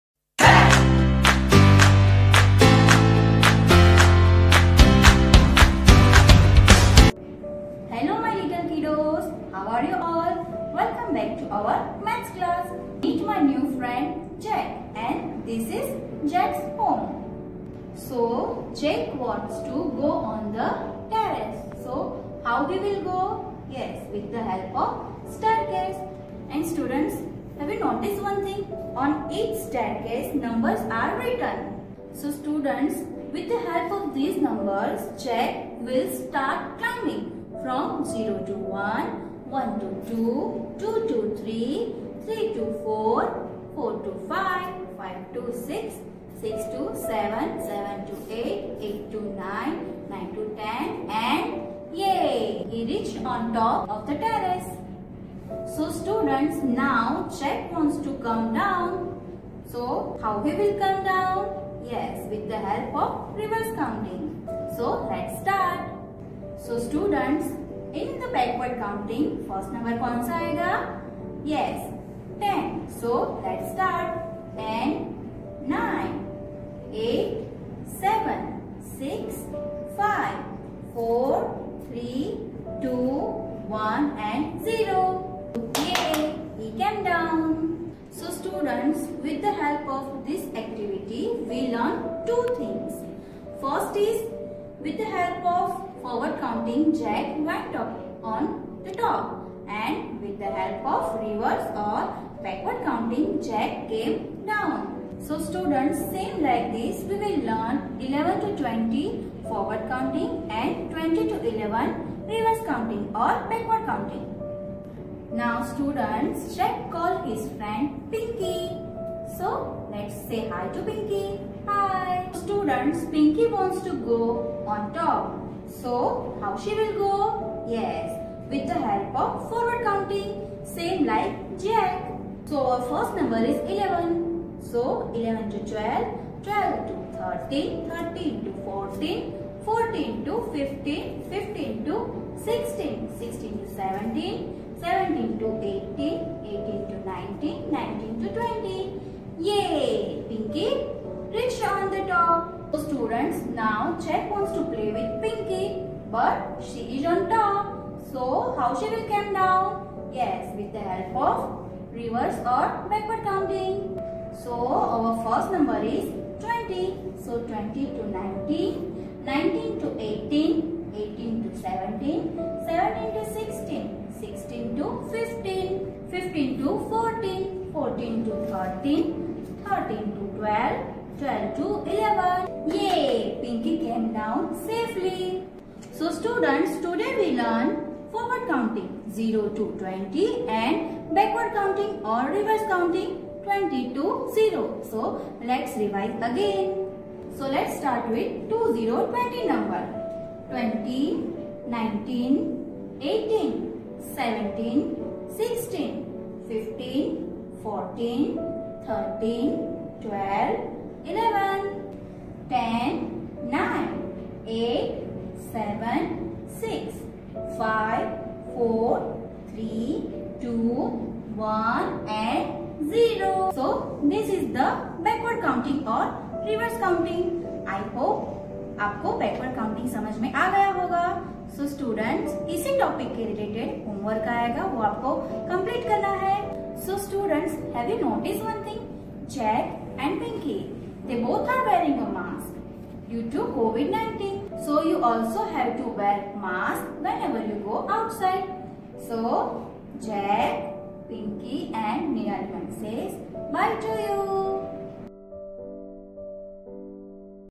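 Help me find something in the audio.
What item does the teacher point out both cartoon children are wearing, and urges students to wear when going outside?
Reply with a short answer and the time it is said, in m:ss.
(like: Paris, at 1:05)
mask, at 4:06.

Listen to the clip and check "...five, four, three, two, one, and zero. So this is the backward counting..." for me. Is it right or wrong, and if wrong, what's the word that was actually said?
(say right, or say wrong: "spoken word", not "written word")
right.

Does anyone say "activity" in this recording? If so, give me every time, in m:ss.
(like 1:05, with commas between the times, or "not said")
1:30.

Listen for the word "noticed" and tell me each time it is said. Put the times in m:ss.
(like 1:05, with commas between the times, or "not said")
0:27.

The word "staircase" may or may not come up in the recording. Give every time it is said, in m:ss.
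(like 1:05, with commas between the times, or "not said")
0:25, 0:29.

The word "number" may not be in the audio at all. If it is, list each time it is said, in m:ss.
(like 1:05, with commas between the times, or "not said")
0:30, 0:34, 2:13, 2:45, 3:19.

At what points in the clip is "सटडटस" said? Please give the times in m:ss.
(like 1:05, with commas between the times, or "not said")
3:51, 3:57.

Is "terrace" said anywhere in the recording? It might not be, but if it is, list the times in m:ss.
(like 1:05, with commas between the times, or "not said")
0:21, 0:54.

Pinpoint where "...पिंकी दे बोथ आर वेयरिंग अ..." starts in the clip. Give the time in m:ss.
4:00.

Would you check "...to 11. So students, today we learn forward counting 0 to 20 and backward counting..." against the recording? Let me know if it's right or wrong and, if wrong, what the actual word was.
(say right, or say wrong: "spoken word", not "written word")
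right.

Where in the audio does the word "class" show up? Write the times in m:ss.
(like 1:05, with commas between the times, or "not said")
0:12.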